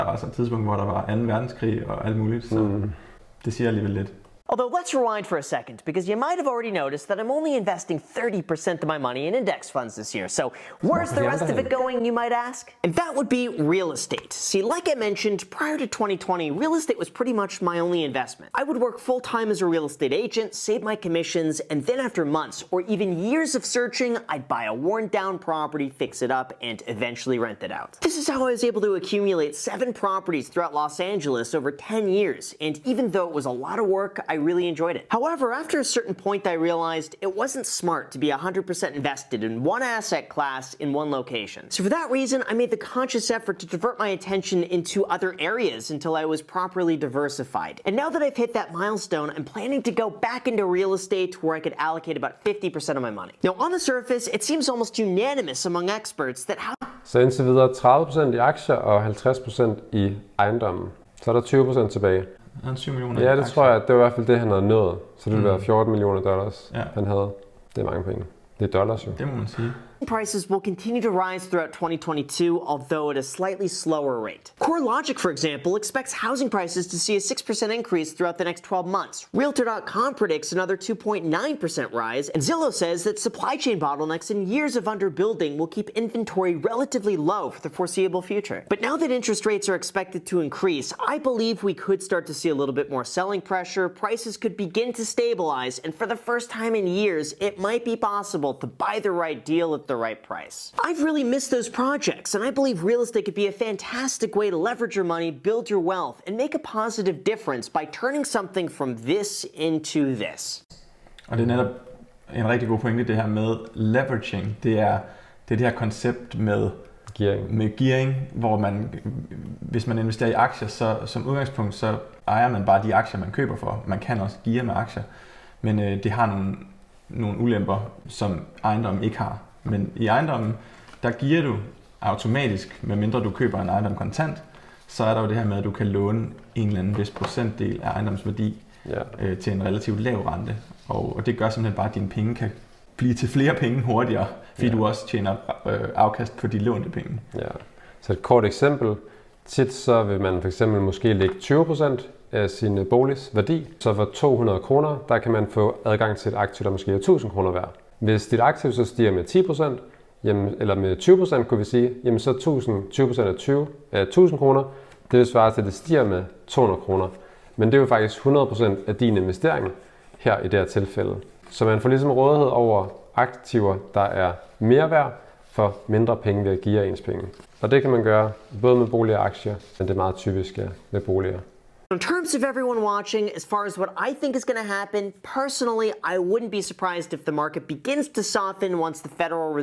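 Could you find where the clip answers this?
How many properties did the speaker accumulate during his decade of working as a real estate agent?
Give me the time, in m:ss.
0:29.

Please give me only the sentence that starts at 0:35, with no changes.
However, after a certain point, I realized it wasn't smart to be 100% invested in one asset class in one location.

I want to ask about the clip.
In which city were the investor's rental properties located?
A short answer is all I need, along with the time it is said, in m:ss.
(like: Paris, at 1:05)
Los Angeles, at 0:30.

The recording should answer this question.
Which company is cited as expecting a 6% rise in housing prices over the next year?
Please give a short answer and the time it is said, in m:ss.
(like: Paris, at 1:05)
CoreLogic, at 1:14.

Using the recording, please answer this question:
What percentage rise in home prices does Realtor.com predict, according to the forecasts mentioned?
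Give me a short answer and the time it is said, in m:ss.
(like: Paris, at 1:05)
2.9%, at 1:20.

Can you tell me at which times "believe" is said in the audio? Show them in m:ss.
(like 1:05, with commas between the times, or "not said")
1:31, 1:42.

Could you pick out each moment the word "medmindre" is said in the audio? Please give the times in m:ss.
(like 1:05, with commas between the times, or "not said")
2:12.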